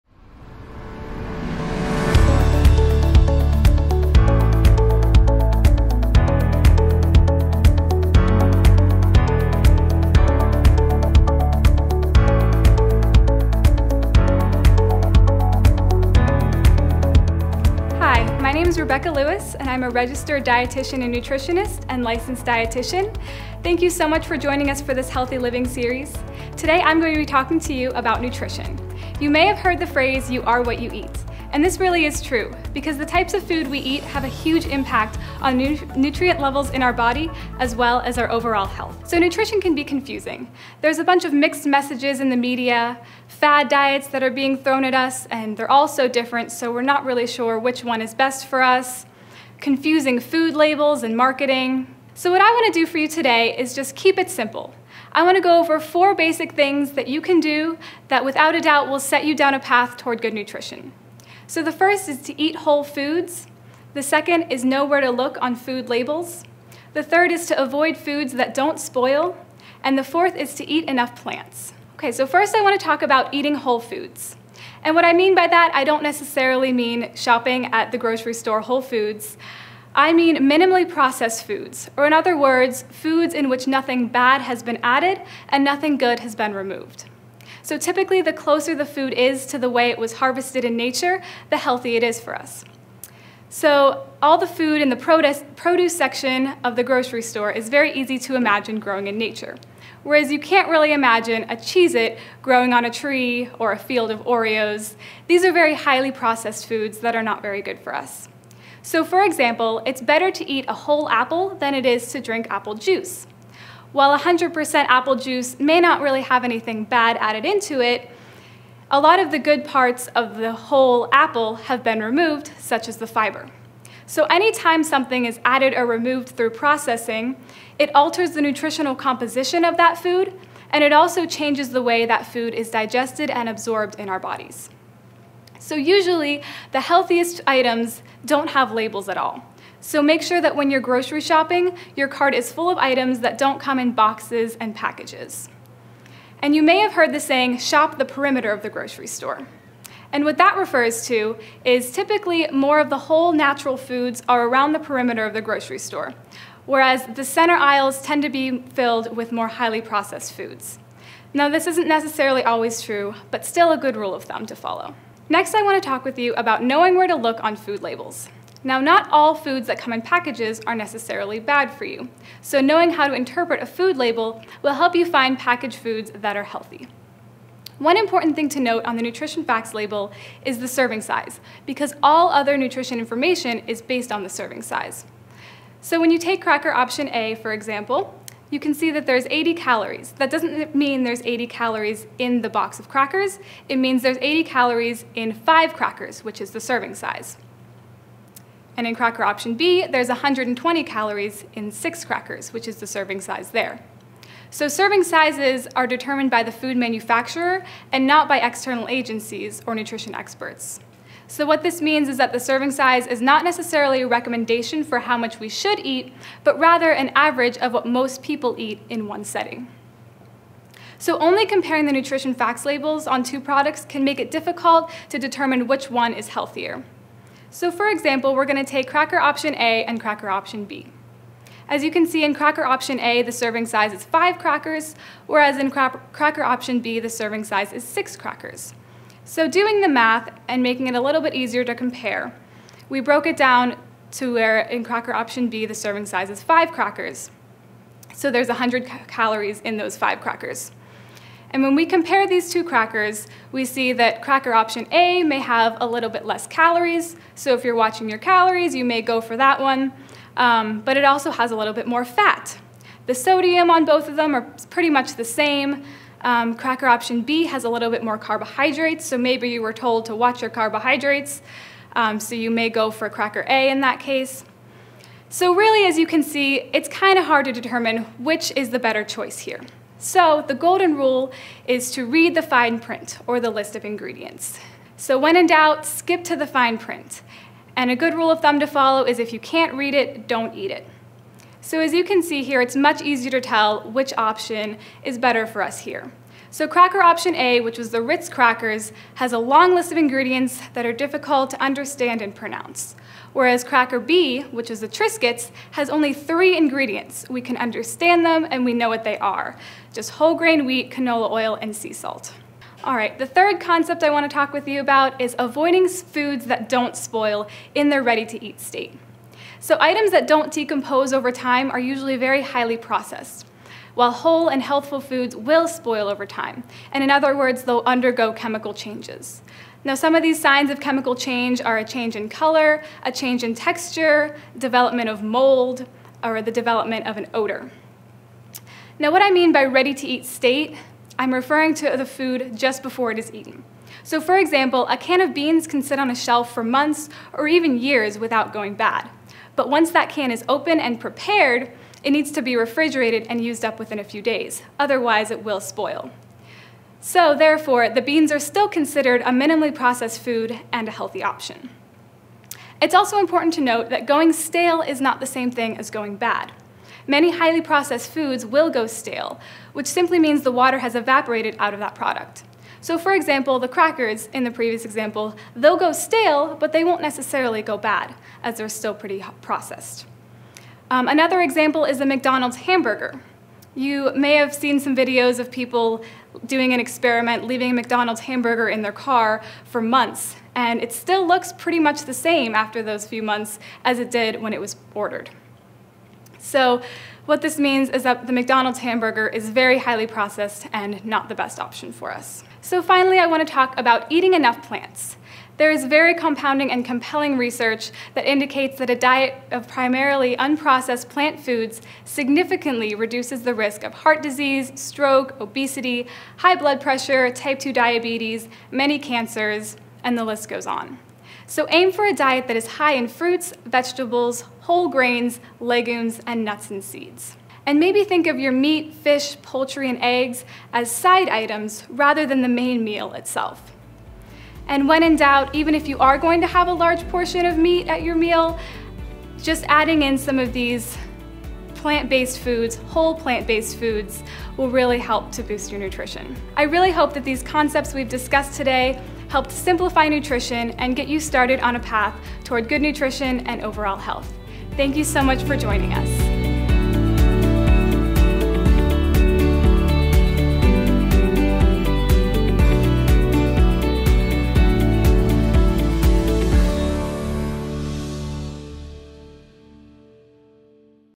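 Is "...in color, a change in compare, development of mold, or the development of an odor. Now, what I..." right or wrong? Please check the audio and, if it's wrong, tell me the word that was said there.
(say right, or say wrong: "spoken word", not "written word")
wrong: "texture", not "compare".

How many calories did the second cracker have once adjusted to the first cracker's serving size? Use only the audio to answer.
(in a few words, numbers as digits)
100.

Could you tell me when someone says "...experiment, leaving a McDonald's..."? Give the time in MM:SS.
06:26.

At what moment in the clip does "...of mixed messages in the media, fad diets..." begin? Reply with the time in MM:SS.
00:41.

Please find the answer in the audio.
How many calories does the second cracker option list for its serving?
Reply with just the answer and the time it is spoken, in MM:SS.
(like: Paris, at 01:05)
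120, at 03:20.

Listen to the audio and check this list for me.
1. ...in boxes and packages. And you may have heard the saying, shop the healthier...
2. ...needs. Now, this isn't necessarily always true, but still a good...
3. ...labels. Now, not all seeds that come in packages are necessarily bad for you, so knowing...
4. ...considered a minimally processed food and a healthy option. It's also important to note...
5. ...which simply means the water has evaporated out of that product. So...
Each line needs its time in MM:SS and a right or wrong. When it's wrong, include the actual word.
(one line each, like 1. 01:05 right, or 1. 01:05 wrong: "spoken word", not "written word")
1. 02:23 wrong: "perimeter", not "healthier"
2. 02:40 wrong: "foods", not "needs"
3. 02:47 wrong: "foods", not "seeds"
4. 05:58 right
5. 06:09 right.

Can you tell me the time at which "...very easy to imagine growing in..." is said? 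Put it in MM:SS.
01:37.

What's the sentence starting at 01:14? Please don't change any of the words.
And what I mean by that, I don't necessarily mean shopping at the grocery store Whole Foods.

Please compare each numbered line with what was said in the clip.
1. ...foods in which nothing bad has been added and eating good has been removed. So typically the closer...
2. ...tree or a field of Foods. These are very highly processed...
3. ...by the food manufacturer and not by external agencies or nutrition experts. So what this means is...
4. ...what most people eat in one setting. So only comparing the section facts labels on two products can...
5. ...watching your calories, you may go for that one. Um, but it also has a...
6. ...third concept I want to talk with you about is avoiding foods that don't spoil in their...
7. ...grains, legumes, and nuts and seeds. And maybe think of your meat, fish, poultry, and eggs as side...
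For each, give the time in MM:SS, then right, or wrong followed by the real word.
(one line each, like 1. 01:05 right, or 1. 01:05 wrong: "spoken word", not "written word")
1. 01:22 wrong: "nothing", not "eating"
2. 01:42 wrong: "Oreos", not "Foods"
3. 03:26 right
4. 03:37 wrong: "nutrition", not "section"
5. 04:17 right
6. 05:13 right
7. 07:04 right.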